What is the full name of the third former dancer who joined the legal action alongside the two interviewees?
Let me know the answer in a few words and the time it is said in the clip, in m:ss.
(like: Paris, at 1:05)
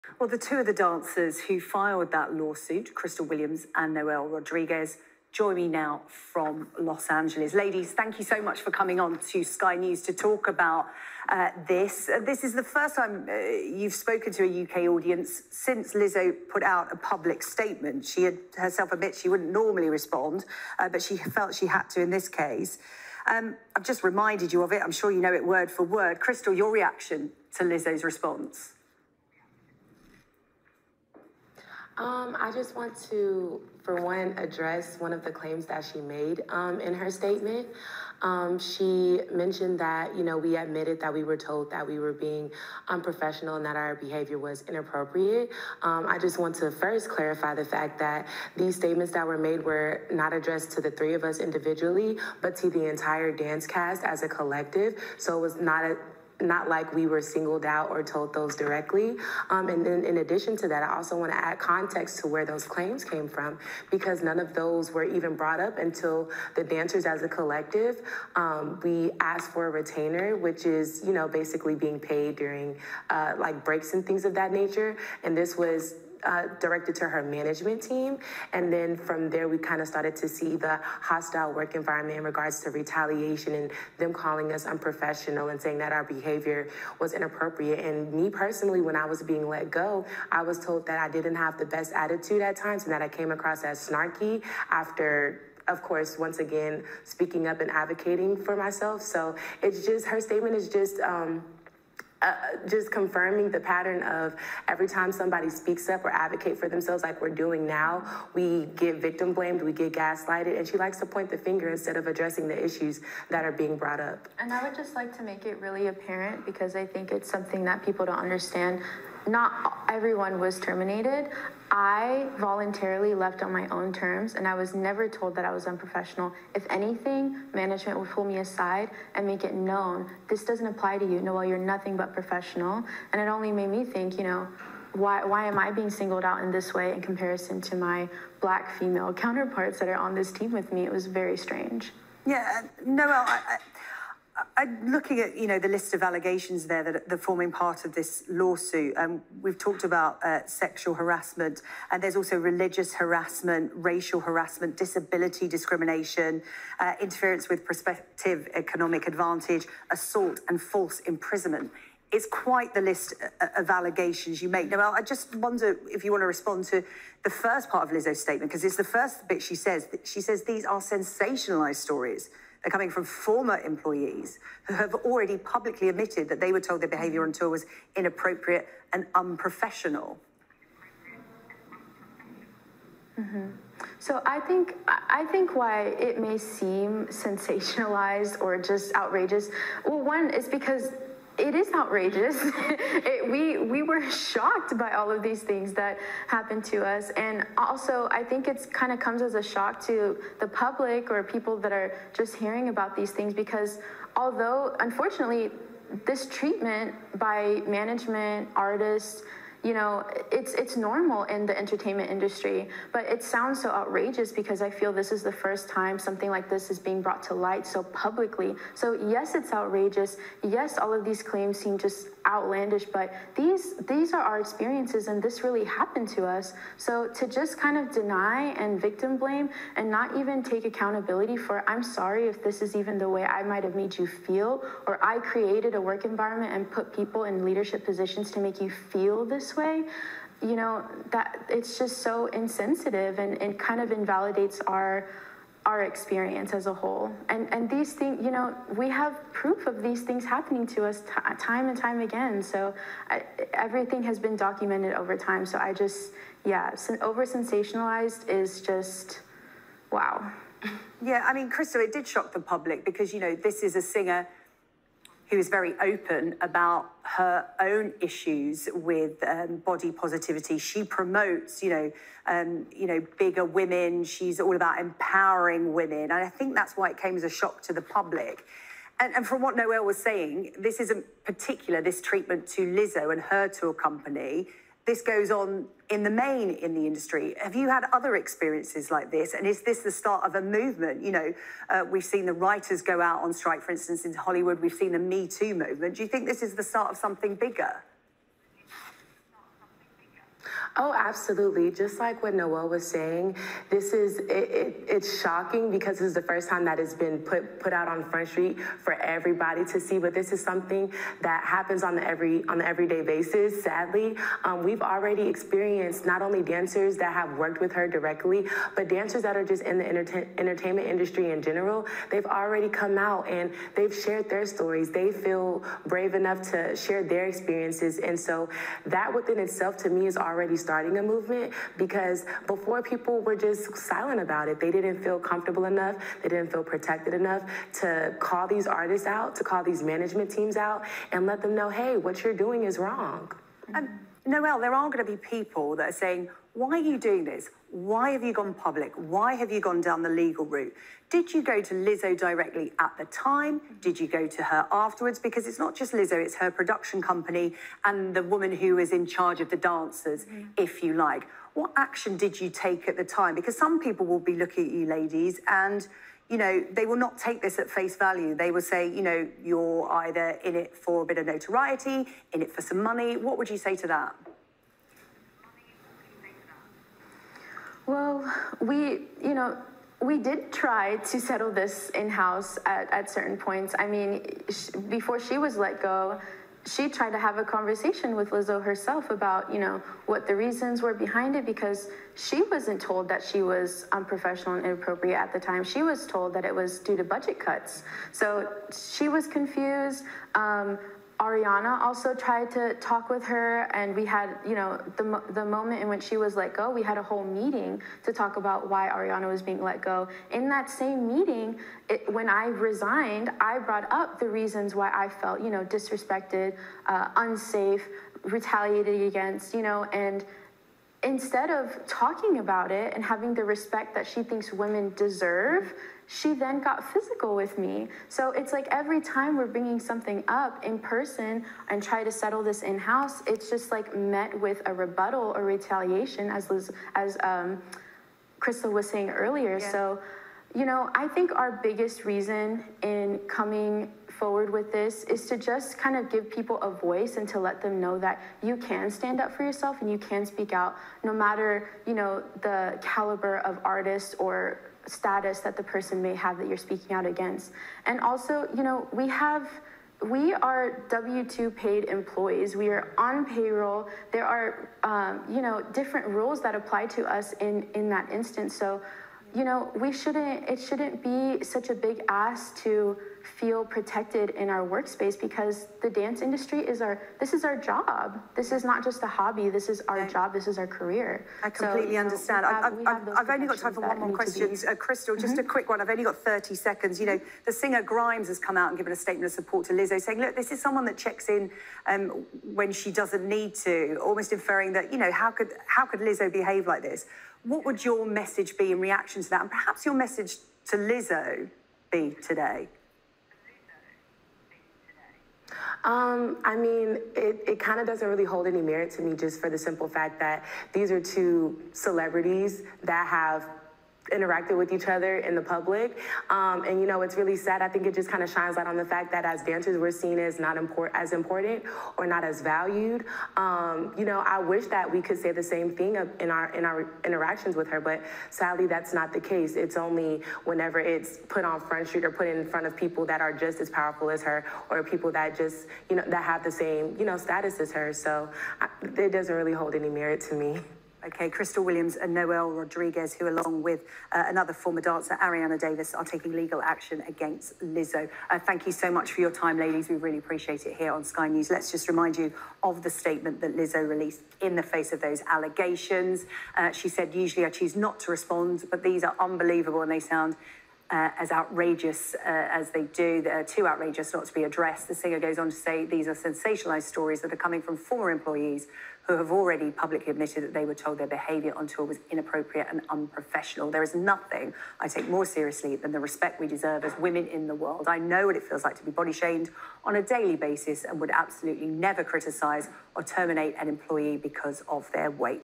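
Arianna Davis, at 9:05.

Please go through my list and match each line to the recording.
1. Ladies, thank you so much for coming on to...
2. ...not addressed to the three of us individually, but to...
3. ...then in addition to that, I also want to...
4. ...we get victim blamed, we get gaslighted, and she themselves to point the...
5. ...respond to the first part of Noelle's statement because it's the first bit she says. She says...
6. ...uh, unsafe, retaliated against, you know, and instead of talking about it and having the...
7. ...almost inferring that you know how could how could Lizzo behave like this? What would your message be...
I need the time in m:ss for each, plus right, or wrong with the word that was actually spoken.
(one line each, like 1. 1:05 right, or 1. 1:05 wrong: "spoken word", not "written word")
1. 0:07 right
2. 0:50 right
3. 0:59 right
4. 1:48 wrong: "likes", not "themselves"
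5. 2:46 wrong: "Lizzo", not "Noelle"
6. 6:56 right
7. 8:14 right.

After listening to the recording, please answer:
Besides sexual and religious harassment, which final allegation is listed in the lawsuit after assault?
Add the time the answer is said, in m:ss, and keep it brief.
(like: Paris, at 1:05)
false imprisonment, at 2:40.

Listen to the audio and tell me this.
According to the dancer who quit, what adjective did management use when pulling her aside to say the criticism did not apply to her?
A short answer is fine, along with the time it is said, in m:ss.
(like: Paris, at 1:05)
professional, at 2:11.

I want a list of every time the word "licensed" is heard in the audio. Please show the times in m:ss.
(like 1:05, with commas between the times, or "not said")
not said.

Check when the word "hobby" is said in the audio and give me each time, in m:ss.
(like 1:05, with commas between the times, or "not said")
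7:59.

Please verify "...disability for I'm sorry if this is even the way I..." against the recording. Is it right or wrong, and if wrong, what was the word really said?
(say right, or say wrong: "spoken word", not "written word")
wrong: "accountability", not "disability".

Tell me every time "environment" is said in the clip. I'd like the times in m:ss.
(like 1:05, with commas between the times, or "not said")
1:21, 3:56.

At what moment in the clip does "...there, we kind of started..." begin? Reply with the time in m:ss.
1:19.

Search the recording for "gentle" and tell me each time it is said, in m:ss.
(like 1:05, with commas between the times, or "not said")
not said.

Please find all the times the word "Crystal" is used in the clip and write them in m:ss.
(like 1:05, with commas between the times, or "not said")
0:02, 0:26, 4:21, 7:18, 8:04, 9:01.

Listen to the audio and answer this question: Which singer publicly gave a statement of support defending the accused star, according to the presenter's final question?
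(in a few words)
Grimes.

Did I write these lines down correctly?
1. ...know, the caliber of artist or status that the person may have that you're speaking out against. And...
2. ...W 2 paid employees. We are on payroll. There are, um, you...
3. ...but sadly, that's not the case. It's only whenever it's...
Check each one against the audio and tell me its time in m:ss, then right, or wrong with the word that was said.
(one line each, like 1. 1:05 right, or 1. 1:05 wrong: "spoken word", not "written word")
1. 7:31 right
2. 7:40 right
3. 8:47 right.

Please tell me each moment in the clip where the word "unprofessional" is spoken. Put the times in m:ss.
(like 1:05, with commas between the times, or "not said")
0:42, 1:24, 2:05, 2:59, 6:33, 9:32.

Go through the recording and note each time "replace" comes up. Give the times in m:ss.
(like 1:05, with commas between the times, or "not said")
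not said.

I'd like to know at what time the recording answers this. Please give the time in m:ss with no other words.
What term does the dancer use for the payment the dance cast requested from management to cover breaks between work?
1:09.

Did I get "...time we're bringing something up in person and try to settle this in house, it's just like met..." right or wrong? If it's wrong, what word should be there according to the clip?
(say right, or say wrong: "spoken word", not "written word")
right.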